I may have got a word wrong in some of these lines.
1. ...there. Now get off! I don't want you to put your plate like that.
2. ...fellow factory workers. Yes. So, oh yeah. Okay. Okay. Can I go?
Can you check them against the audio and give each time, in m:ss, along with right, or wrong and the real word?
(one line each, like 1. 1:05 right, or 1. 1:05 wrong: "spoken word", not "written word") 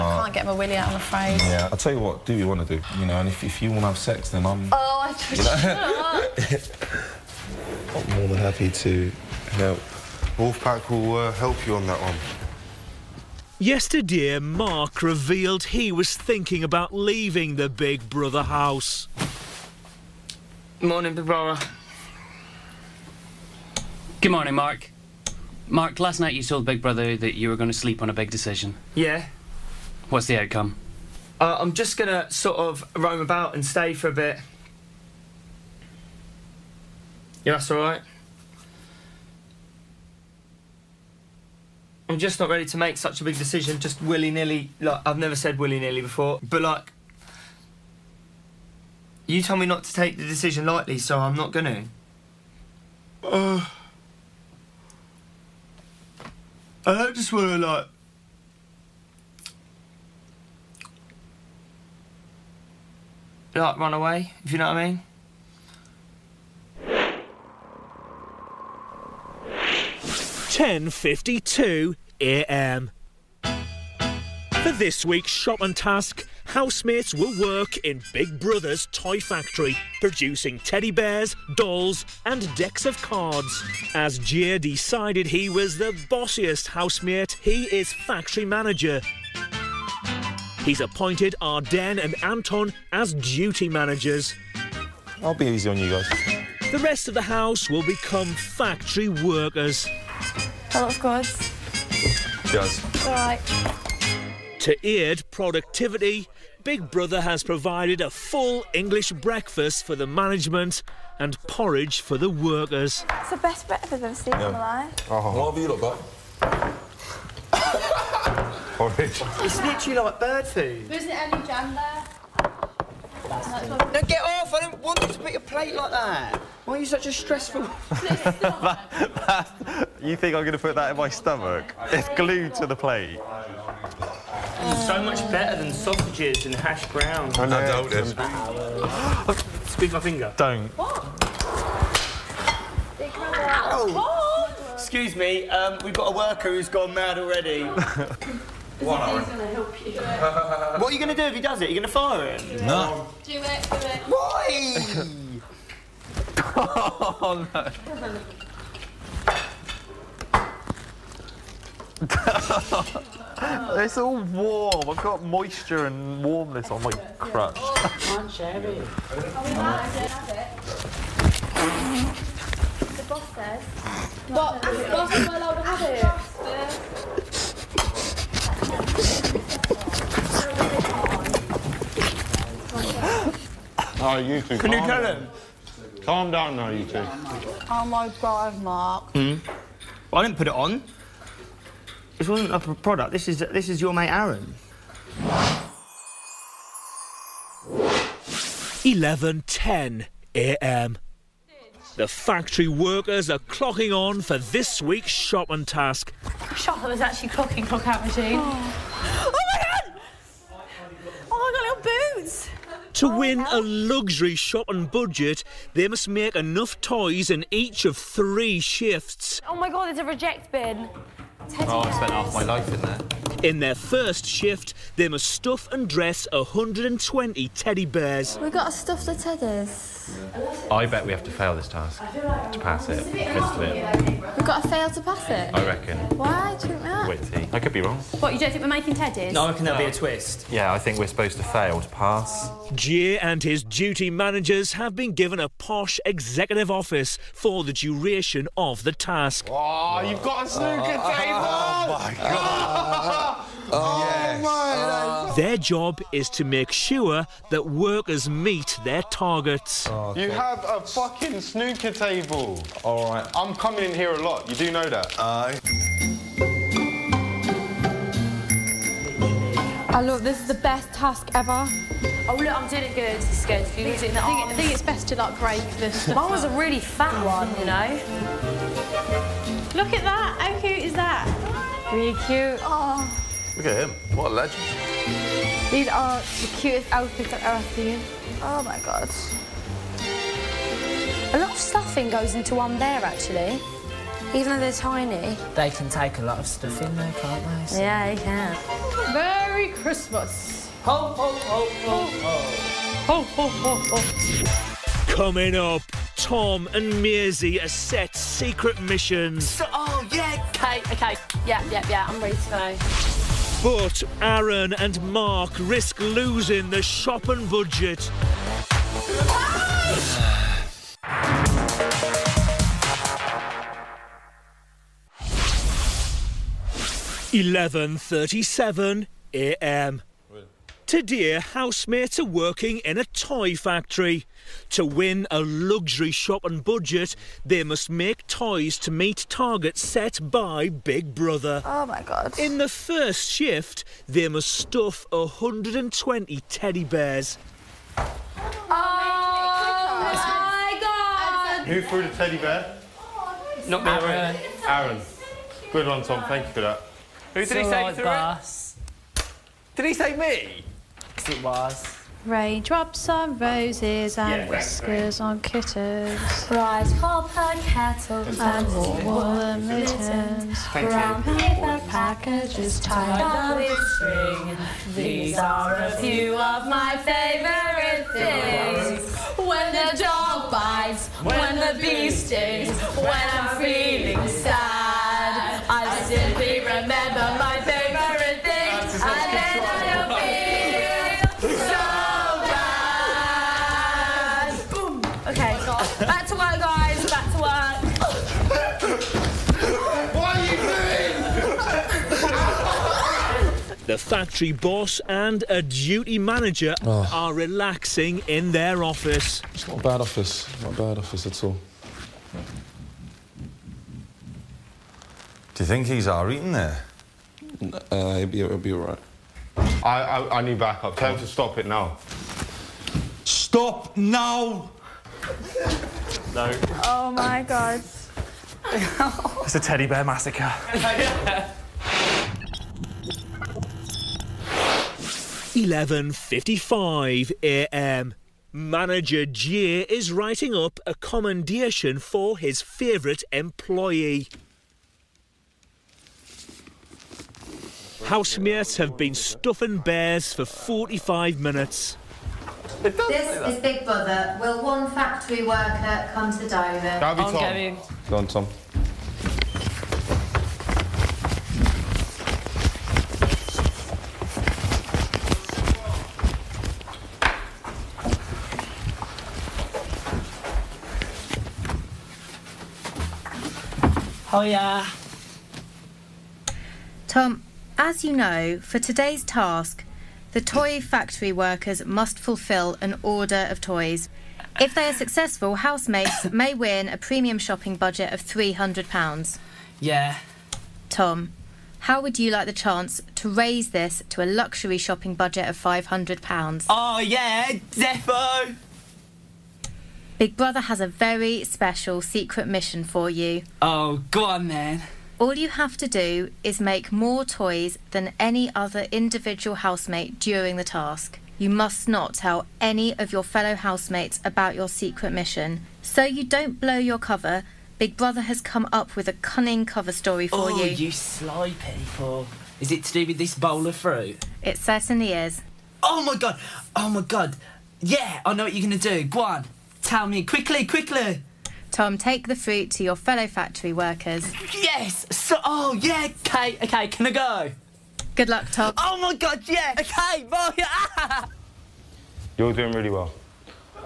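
1. 2:01 right
2. 8:52 right.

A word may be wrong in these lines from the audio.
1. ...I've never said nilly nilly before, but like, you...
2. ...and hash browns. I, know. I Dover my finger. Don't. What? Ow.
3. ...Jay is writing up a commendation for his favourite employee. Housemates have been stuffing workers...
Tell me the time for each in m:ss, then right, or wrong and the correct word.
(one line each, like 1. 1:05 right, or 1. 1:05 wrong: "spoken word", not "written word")
1. 0:45 wrong: "willy", not "nilly"
2. 2:16 wrong: "Squeeze", not "Dover"
3. 7:19 wrong: "bears", not "workers".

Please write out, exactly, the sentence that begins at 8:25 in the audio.
All you have to do is make more toys than any other individual housemate during the task.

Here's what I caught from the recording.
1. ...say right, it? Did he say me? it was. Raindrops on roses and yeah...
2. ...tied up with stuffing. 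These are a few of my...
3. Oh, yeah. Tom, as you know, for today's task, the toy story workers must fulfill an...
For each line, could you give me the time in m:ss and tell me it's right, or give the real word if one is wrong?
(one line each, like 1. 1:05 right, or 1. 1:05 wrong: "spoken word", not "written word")
1. 5:57 right
2. 6:12 wrong: "string", not "stuffing"
3. 7:54 wrong: "factory", not "story".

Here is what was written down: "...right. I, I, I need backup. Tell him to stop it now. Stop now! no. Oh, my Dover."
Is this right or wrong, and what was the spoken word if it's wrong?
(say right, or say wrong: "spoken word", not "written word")
wrong: "God", not "Dover".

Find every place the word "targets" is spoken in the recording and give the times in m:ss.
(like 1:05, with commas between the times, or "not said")
4:19, 5:39.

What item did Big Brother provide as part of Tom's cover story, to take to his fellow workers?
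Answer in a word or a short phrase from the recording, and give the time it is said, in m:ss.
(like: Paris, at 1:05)
Bowl of fruit, at 8:43.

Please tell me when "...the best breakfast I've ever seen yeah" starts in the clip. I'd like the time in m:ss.
1:53.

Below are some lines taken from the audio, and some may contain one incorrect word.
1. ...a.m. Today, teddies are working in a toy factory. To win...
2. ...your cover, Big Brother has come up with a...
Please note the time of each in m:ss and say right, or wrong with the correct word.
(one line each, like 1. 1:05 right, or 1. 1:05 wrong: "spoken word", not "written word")
1. 5:29 wrong: "housemates", not "teddies"
2. 8:36 right.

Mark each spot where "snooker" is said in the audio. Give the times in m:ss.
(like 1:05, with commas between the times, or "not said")
4:10, 4:21.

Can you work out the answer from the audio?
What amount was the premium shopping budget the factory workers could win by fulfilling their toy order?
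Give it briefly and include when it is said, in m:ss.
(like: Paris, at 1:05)
£300, at 8:08.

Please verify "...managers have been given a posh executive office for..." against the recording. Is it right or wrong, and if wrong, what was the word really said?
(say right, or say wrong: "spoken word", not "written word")
right.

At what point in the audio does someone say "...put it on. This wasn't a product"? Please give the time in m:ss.
3:10.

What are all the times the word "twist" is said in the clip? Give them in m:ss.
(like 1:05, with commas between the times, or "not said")
3:59.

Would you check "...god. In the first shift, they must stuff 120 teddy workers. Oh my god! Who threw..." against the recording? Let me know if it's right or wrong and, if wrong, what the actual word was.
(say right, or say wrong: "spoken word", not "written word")
wrong: "bears", not "workers".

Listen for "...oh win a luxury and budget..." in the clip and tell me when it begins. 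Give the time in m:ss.
3:33.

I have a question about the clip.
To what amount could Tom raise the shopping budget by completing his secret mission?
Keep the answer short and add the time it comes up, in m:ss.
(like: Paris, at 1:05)
£500, at 8:15.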